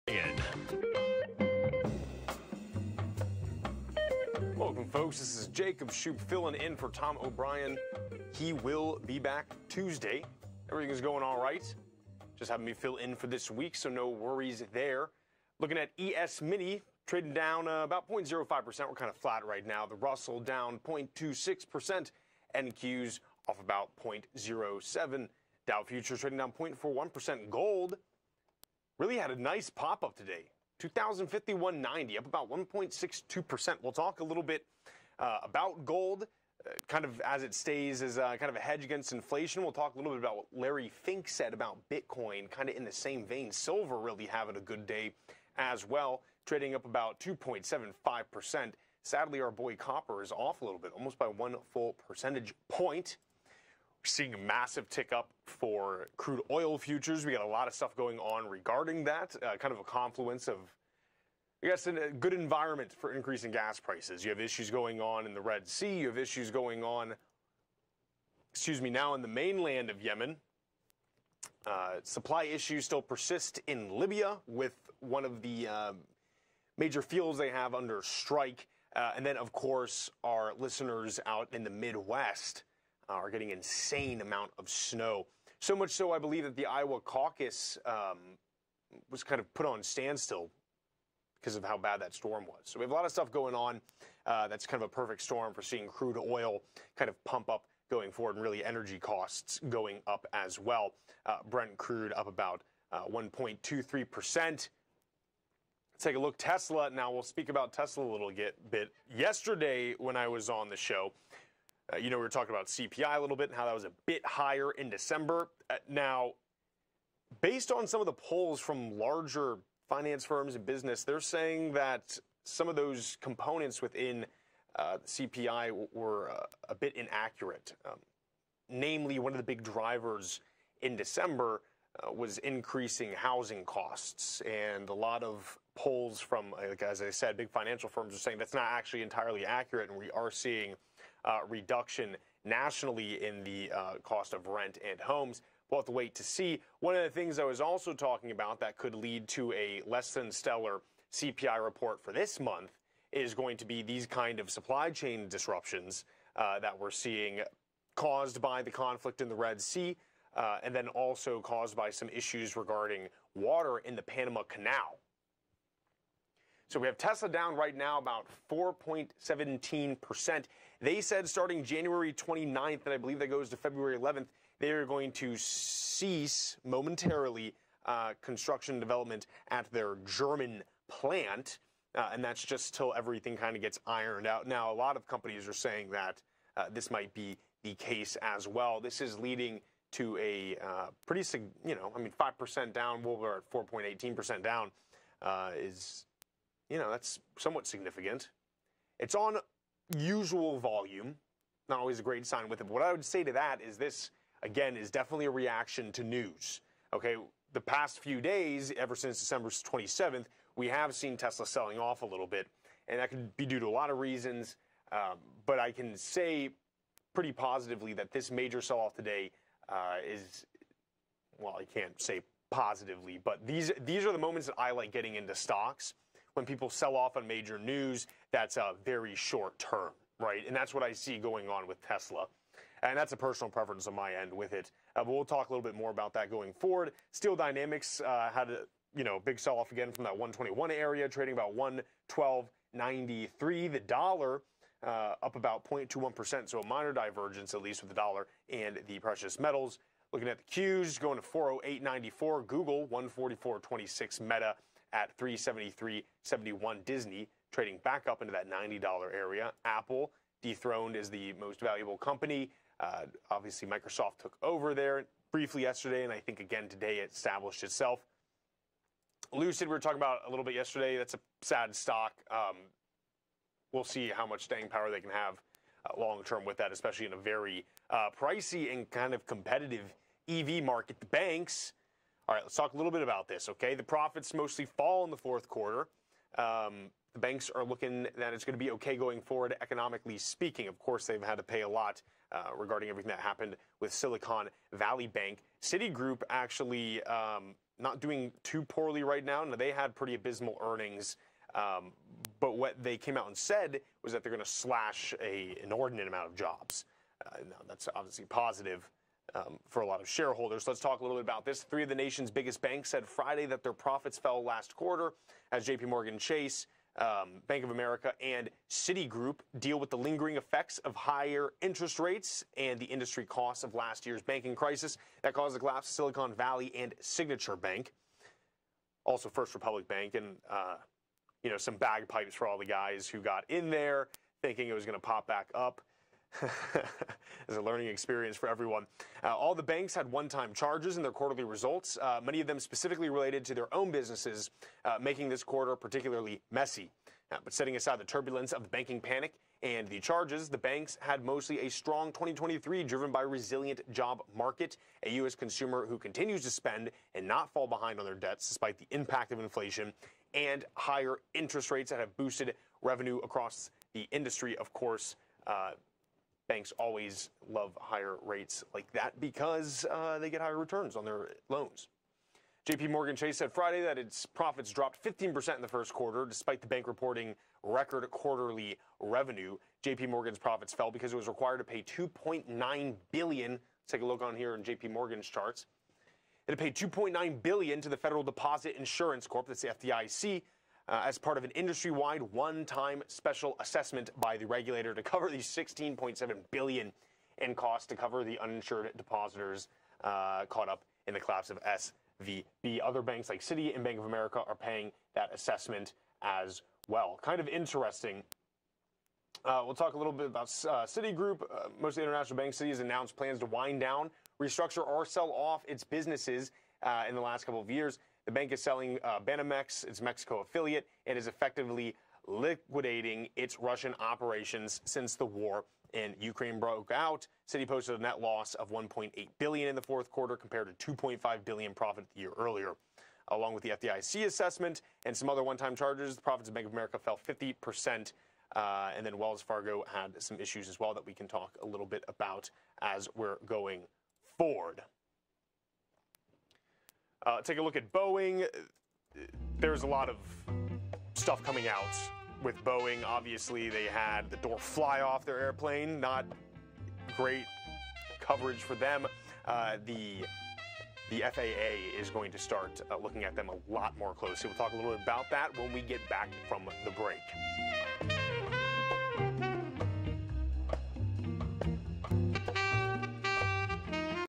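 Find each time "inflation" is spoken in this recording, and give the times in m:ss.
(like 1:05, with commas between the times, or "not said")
0:39, 5:59.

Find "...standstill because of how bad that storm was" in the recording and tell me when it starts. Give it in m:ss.
1:29.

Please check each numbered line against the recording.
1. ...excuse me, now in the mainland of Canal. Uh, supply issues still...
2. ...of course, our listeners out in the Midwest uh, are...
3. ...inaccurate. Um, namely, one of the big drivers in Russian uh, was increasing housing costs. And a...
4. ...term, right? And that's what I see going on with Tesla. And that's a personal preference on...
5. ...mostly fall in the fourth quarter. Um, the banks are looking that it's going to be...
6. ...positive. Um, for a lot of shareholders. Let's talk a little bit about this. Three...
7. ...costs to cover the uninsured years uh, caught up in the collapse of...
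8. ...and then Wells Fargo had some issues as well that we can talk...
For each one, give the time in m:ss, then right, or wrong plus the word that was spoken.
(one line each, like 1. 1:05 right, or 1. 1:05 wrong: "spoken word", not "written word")
1. 1:08 wrong: "Yemen", not "Canal"
2. 1:19 right
3. 2:06 wrong: "December", not "Russian"
4. 3:49 right
5. 4:44 right
6. 5:08 right
7. 6:37 wrong: "depositors", not "years"
8. 7:18 right.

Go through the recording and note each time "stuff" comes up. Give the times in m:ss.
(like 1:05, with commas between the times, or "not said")
0:57, 1:33, 7:31.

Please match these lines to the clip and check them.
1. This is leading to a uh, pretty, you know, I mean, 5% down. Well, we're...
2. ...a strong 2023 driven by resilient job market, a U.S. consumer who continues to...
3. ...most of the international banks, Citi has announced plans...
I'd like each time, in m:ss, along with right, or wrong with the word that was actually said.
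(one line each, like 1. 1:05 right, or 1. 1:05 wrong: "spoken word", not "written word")
1. 3:08 right
2. 5:51 right
3. 6:51 right.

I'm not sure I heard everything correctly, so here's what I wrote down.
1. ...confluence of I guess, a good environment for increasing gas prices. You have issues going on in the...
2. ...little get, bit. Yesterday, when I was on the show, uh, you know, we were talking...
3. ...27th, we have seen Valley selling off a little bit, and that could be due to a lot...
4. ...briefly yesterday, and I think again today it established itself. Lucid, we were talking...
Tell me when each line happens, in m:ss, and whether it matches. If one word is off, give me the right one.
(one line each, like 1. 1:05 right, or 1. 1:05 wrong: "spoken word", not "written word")
1. 0:59 right
2. 1:48 right
3. 3:29 wrong: "Tesla", not "Valley"
4. 4:25 right.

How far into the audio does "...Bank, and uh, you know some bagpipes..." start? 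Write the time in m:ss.
5:29.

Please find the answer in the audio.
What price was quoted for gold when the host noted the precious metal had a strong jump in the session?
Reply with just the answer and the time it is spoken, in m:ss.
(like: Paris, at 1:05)
2051.90, at 0:30.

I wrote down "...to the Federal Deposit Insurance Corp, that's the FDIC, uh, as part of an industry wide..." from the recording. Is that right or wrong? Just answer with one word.
right.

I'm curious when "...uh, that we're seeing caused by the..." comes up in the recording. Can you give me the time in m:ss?
2:36.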